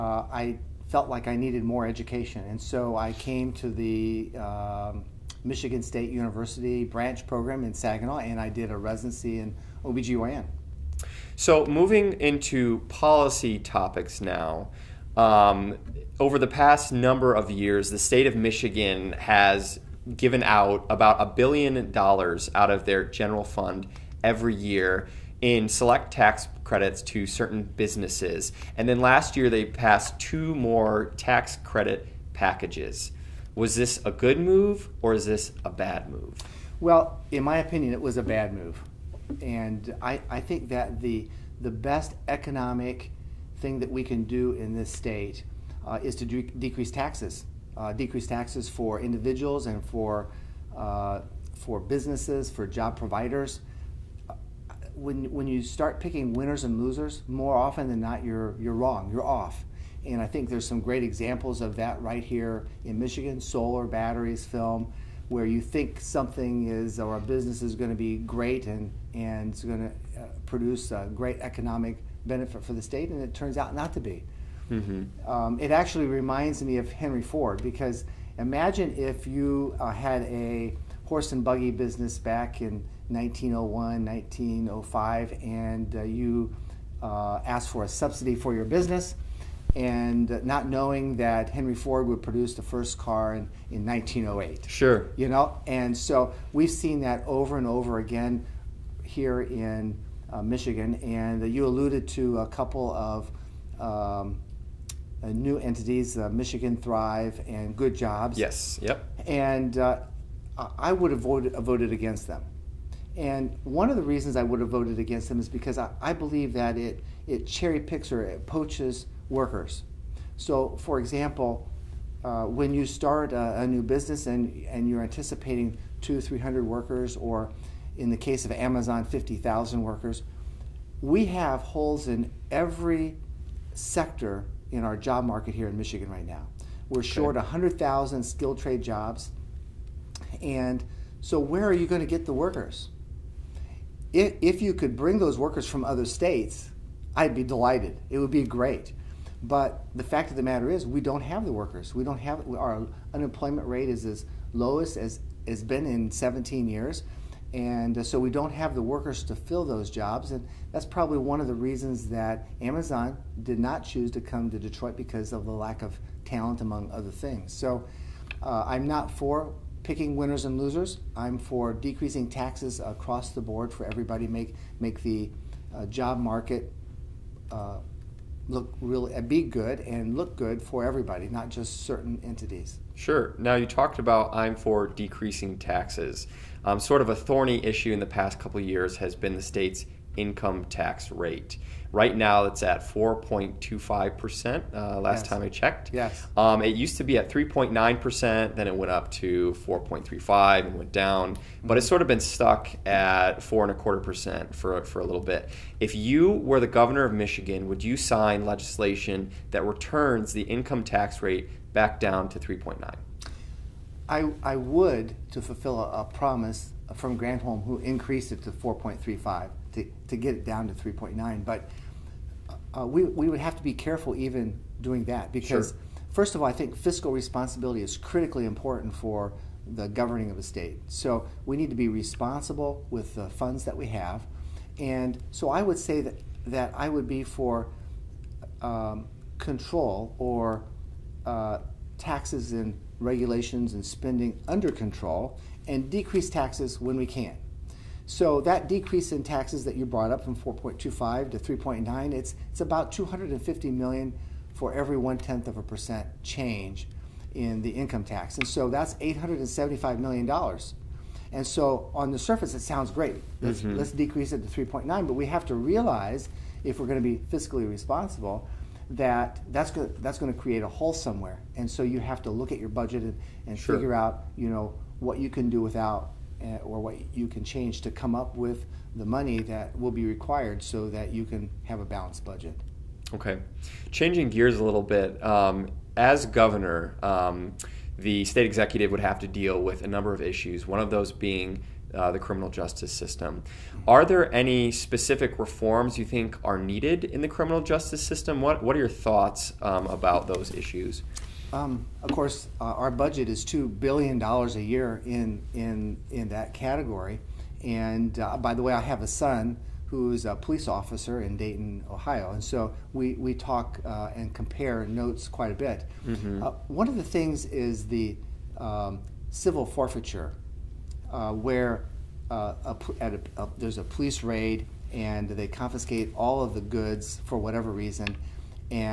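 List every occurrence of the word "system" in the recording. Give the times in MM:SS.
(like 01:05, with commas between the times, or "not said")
04:52, 04:58.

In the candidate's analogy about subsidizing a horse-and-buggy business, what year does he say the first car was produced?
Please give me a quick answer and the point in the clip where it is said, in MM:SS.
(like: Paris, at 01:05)
1908, at 01:33.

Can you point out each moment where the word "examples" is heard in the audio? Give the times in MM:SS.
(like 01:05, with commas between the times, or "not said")
01:01, 02:00.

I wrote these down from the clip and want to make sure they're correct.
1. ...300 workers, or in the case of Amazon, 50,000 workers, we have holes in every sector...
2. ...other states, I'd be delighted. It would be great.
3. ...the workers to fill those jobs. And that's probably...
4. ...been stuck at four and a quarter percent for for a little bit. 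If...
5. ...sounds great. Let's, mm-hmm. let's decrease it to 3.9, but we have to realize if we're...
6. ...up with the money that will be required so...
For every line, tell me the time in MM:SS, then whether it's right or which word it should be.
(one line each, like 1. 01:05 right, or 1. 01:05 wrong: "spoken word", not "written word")
1. 02:06 right
2. 02:25 right
3. 02:38 right
4. 03:22 right
5. 04:22 right
6. 04:38 right.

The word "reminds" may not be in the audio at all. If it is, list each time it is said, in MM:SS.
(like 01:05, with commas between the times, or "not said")
01:16.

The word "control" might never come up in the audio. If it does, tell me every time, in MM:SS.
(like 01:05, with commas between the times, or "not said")
03:59, 04:04.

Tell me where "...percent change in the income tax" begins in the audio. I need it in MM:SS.
04:15.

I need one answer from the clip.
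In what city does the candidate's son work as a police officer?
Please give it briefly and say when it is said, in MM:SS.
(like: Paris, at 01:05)
Dayton, Ohio, at 05:11.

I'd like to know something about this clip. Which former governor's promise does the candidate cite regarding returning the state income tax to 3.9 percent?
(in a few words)
Granholm.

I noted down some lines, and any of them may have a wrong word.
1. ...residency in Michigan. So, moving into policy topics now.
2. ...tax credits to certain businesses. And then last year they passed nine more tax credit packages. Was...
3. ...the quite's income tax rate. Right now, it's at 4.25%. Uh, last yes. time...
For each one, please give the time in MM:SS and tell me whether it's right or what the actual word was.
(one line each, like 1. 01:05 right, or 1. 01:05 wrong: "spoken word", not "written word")
1. 00:08 wrong: "OBGYN", not "Michigan"
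2. 00:26 wrong: "two", not "nine"
3. 03:09 wrong: "state", not "quite".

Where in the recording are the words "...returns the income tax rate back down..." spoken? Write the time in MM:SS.
03:29.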